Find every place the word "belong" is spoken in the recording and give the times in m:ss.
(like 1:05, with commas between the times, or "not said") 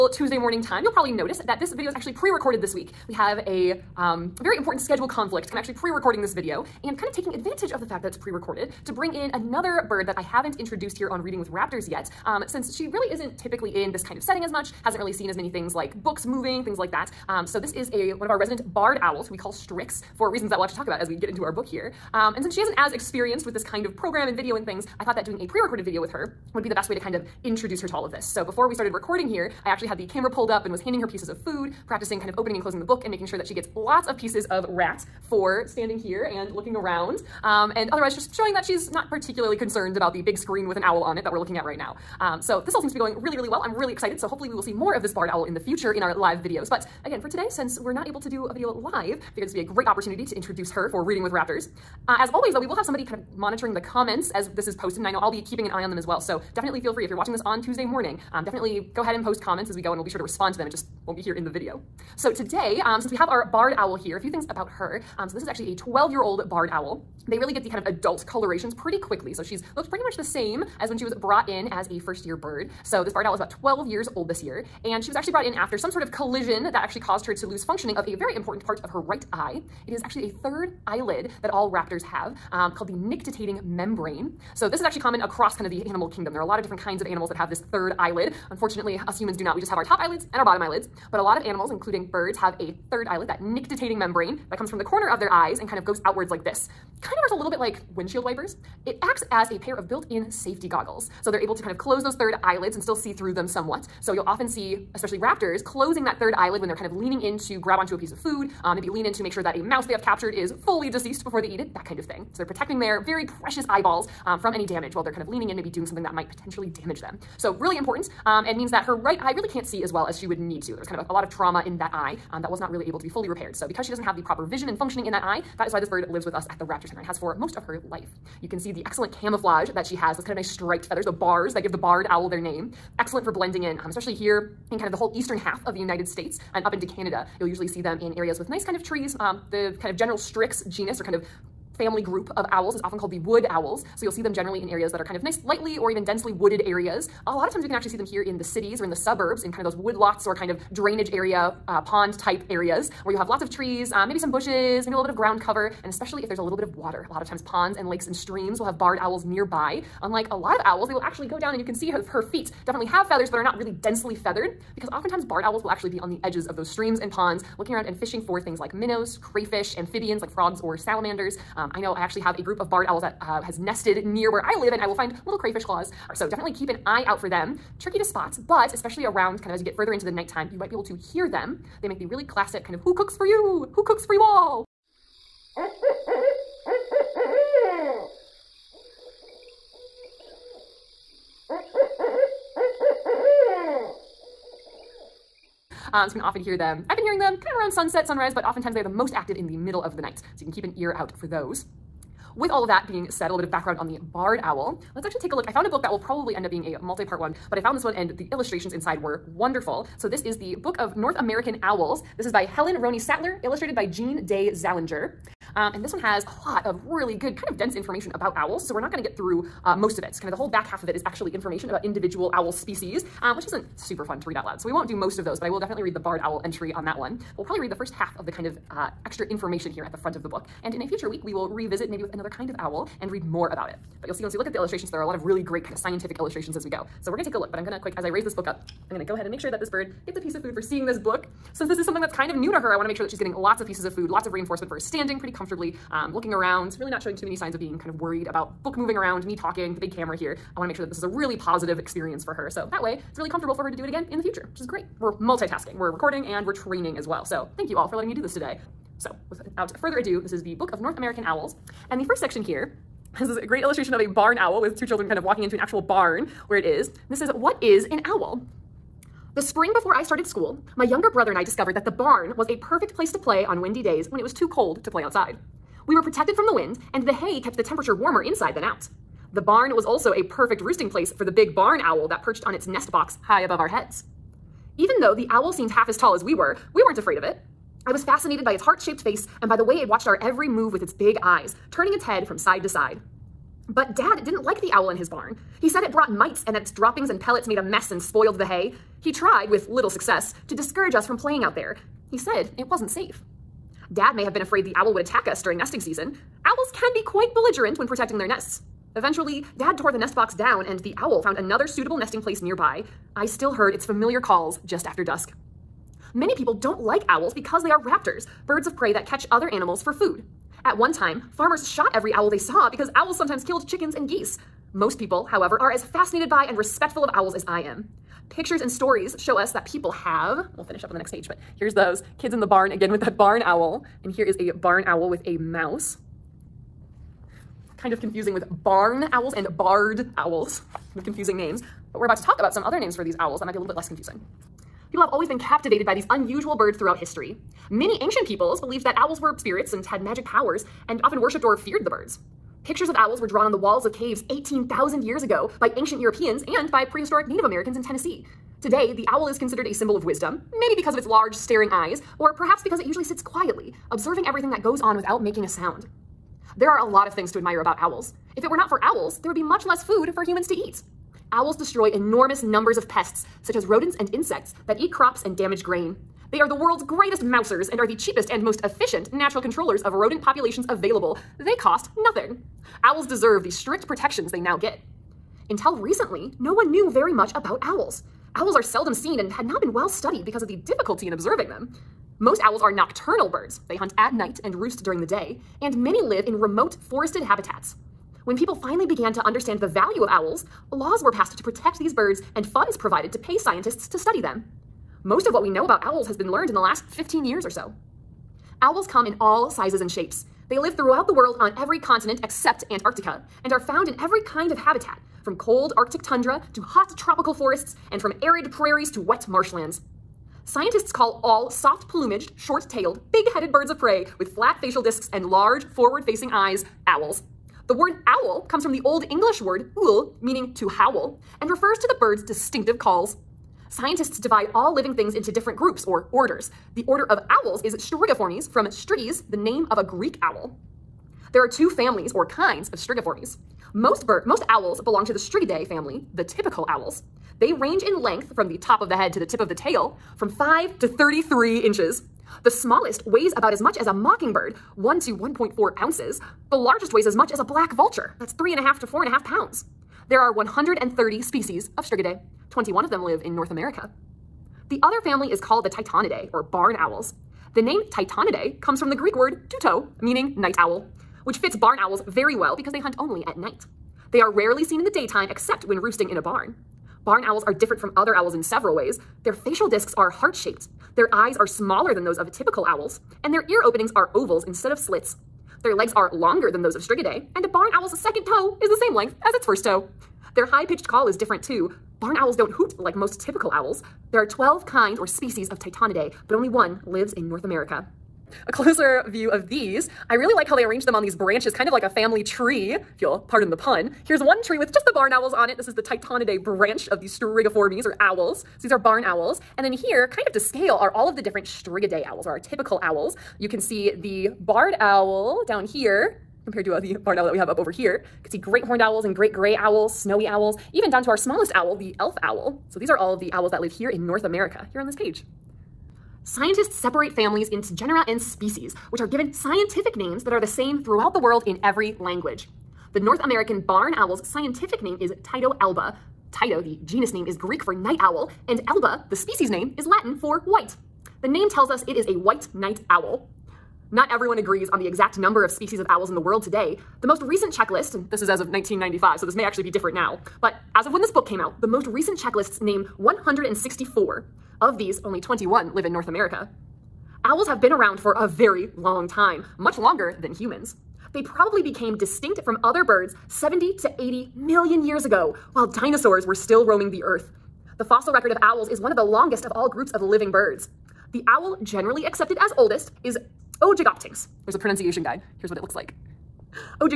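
7:24.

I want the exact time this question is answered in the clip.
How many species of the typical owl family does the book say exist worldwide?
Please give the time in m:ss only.
7:40.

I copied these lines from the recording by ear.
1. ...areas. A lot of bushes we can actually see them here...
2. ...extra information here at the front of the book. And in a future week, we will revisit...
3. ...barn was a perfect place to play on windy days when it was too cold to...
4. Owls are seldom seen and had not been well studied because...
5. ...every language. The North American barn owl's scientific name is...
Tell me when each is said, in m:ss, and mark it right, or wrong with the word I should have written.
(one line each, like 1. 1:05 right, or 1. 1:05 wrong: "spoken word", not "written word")
1. 2:26 wrong: "times", not "bushes"
2. 3:49 right
3. 4:31 right
4. 6:28 right
5. 8:51 right.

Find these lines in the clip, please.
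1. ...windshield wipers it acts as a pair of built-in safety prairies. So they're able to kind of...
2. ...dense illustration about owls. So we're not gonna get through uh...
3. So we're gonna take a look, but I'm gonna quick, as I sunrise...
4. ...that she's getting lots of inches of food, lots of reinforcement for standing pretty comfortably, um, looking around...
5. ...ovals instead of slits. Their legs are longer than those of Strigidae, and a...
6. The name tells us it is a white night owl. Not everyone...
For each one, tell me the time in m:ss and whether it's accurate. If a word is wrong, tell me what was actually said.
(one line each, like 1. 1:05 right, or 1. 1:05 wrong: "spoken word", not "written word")
1. 1:37 wrong: "goggles", not "prairies"
2. 3:37 wrong: "information", not "illustration"
3. 3:57 wrong: "raise", not "sunrise"
4. 4:03 wrong: "pieces", not "inches"
5. 8:04 right
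6. 9:01 right.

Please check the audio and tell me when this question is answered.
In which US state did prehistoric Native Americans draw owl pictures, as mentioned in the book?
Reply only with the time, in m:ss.
5:57.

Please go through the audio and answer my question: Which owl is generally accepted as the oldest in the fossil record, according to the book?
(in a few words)
Ogygoptynx.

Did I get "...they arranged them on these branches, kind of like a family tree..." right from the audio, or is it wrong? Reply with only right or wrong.
right.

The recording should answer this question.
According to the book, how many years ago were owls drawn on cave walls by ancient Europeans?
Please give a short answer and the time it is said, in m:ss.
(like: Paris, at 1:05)
18,000, at 5:54.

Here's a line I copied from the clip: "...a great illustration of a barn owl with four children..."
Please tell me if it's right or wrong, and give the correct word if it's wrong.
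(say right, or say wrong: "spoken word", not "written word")
wrong: "two", not "four".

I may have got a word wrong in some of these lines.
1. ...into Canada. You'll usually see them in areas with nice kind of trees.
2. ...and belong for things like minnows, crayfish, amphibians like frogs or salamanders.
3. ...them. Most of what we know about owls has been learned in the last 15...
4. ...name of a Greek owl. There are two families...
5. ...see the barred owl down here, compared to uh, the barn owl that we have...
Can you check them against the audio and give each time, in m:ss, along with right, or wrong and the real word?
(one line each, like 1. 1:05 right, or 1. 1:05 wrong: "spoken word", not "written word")
1. 2:16 right
2. 2:47 wrong: "fishing", not "belong"
3. 6:44 right
4. 7:19 right
5. 8:33 right.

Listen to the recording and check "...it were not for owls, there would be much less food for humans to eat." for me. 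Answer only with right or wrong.
right.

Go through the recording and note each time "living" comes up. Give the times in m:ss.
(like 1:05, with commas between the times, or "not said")
7:14, 9:30.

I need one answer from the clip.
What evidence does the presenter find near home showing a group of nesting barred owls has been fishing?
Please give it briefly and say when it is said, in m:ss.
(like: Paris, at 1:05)
little crayfish claws, at 2:55.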